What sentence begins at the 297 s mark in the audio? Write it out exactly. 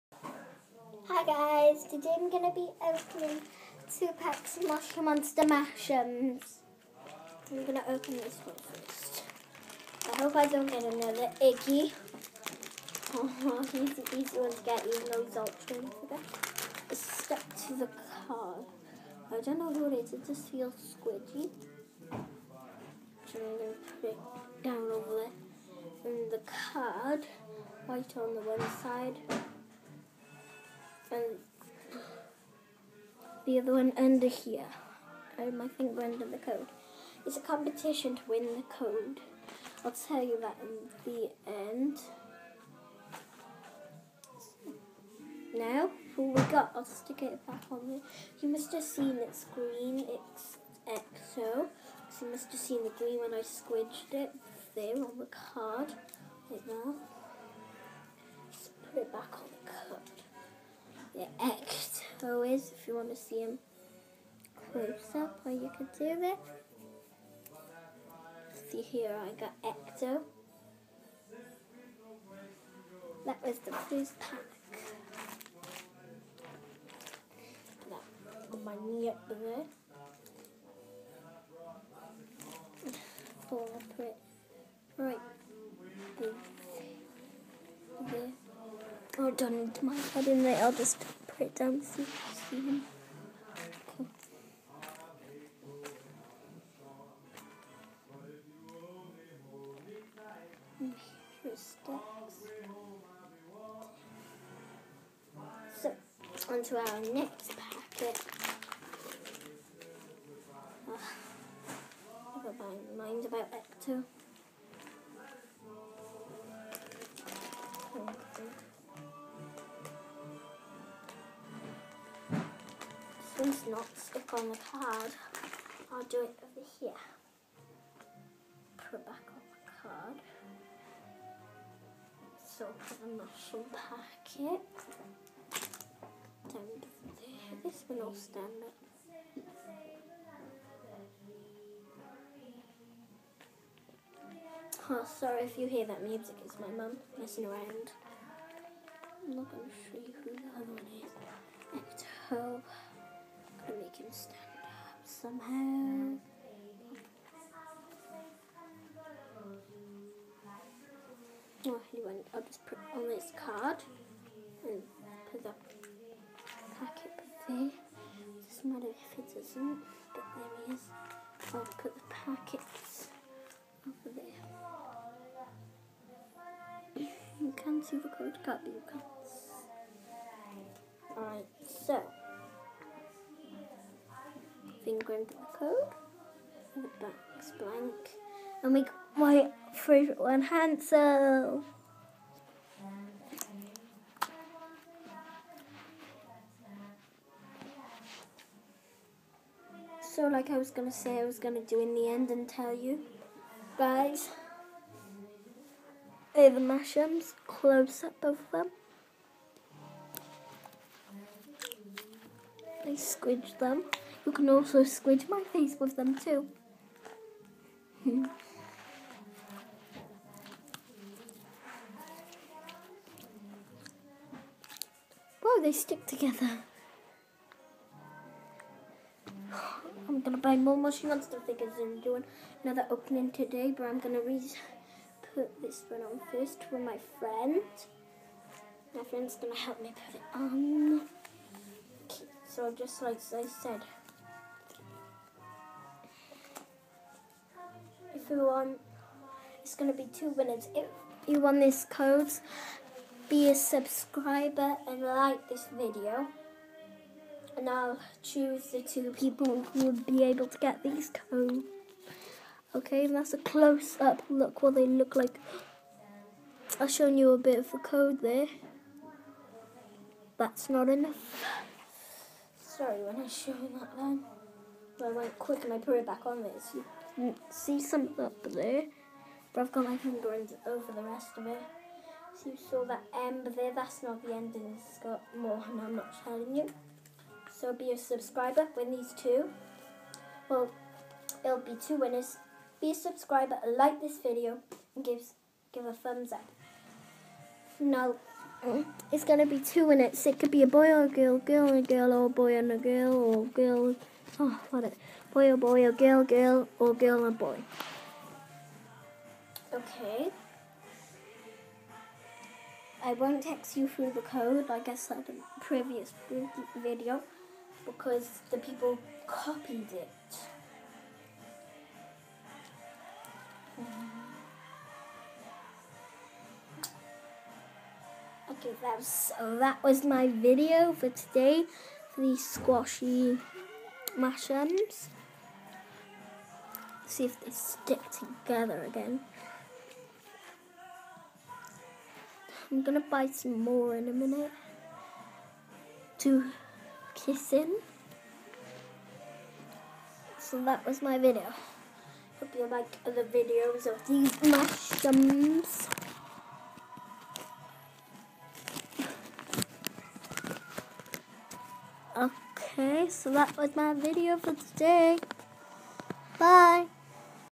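No, it's going to be two winners.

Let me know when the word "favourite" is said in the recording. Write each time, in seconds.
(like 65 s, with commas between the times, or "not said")
189 s.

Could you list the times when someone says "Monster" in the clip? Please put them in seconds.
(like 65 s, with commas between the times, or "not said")
5 s, 231 s.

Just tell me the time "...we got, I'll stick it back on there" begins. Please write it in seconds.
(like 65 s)
46 s.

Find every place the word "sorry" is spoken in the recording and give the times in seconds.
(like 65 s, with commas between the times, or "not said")
145 s, 272 s.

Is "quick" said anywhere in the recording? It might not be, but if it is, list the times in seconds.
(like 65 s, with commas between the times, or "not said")
275 s.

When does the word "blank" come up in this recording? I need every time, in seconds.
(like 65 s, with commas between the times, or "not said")
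187 s.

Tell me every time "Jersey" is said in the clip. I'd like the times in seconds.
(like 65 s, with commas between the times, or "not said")
not said.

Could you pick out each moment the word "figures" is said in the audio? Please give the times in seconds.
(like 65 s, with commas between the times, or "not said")
231 s.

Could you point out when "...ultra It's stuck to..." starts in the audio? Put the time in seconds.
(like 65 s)
15 s.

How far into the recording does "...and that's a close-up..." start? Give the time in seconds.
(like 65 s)
263 s.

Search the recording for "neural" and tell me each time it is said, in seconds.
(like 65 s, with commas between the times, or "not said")
not said.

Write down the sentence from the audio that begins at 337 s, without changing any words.
See if they stick together again.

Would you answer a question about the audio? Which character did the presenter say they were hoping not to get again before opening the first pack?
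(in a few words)
Iggy.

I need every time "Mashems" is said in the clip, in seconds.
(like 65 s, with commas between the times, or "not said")
5 s.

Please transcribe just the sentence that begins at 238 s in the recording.
My friend's gonna help me put it on.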